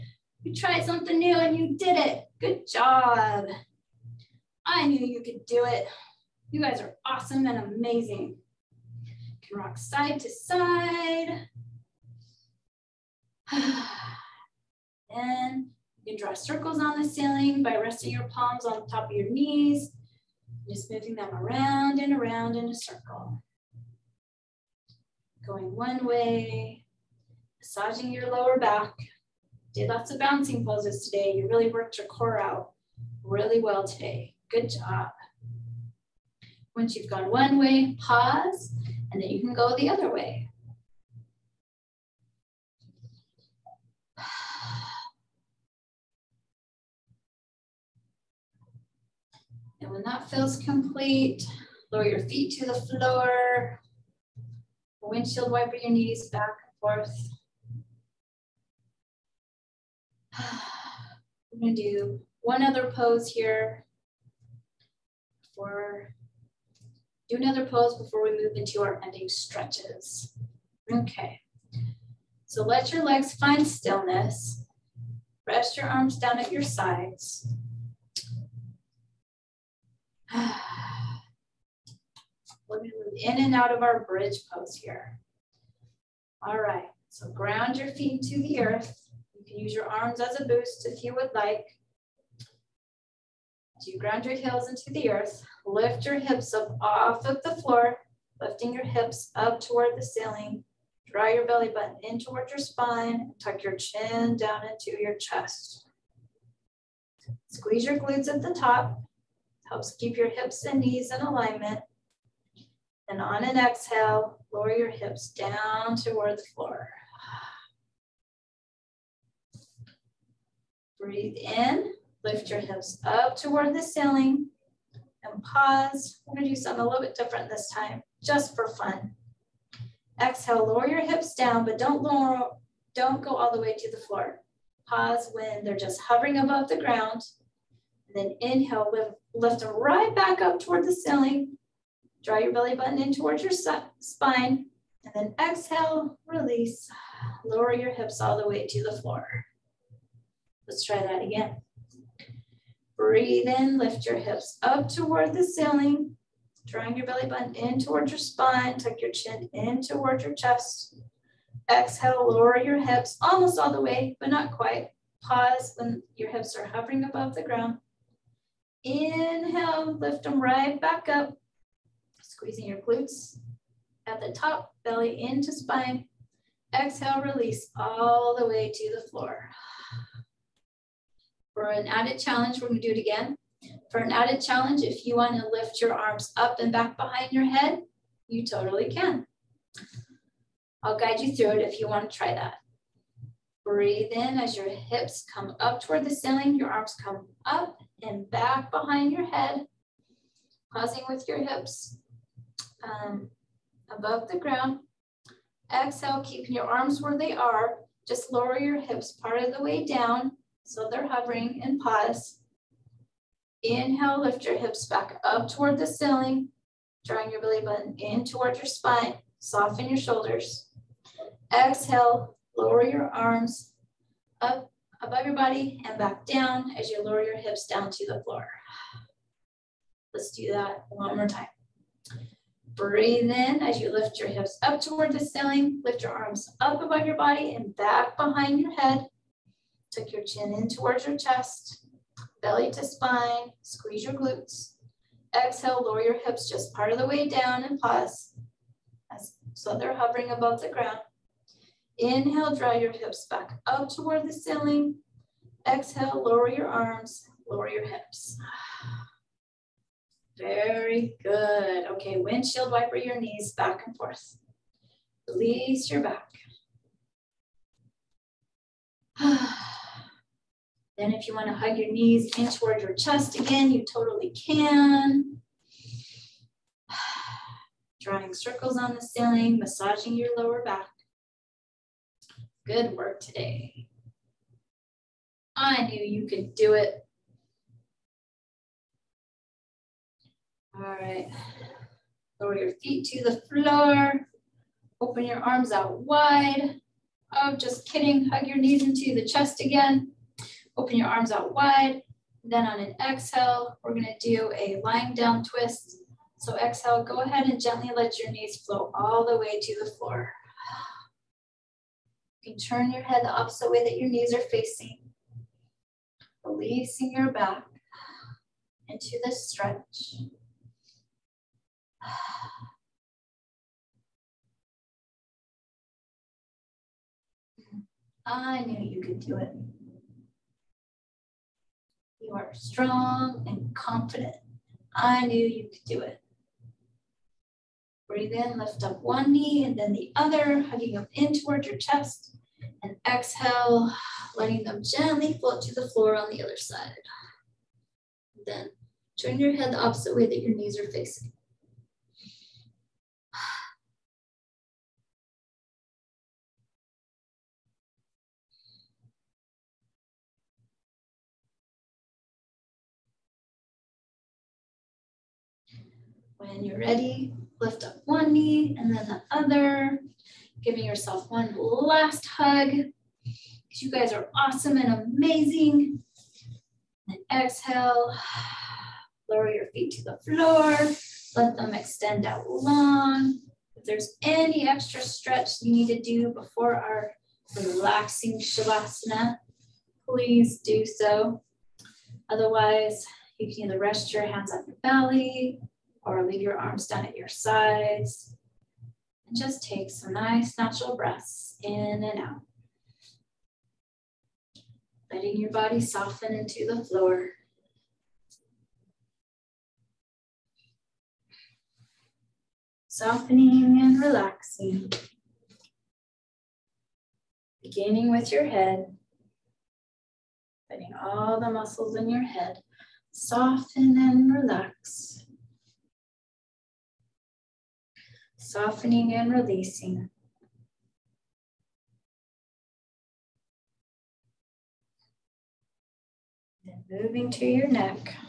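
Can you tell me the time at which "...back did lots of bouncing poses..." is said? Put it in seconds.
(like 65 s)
28 s.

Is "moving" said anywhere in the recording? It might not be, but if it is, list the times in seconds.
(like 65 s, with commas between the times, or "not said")
20 s, 436 s.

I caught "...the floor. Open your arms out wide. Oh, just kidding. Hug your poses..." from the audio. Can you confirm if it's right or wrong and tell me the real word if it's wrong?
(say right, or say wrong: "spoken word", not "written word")
wrong: "knees", not "poses".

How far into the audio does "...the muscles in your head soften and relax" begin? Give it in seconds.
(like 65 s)
421 s.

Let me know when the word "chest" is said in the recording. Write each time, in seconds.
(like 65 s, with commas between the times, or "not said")
105 s, 160 s, 241 s, 272 s, 299 s, 341 s.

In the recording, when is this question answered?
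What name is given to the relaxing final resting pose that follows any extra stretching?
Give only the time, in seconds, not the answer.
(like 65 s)
388 s.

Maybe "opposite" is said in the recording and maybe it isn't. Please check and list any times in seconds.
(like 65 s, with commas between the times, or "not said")
313 s, 349 s.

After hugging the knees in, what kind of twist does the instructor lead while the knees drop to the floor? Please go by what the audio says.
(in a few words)
lying down twist.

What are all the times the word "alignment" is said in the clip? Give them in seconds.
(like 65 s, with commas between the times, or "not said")
111 s.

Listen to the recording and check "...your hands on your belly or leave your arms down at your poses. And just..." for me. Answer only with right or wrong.
wrong.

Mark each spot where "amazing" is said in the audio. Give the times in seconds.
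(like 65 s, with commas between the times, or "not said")
7 s, 375 s.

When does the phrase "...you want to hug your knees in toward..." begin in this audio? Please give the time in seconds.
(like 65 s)
271 s.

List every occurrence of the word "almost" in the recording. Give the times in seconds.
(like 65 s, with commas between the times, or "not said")
163 s.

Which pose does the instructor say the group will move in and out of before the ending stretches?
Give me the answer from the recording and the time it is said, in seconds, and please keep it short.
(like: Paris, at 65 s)
bridge pose, at 84 s.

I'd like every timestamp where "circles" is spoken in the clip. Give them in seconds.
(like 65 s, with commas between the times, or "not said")
16 s, 22 s, 278 s.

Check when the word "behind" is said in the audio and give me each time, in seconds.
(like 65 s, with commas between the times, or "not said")
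186 s, 198 s, 238 s.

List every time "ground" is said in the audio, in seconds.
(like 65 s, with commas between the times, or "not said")
87 s, 93 s, 136 s, 167 s, 204 s, 250 s.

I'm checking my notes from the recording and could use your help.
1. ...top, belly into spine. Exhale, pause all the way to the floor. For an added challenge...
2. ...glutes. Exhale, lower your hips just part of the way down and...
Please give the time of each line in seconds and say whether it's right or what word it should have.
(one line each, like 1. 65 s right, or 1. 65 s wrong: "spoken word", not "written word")
1. 174 s wrong: "release", not "pause"
2. 244 s right.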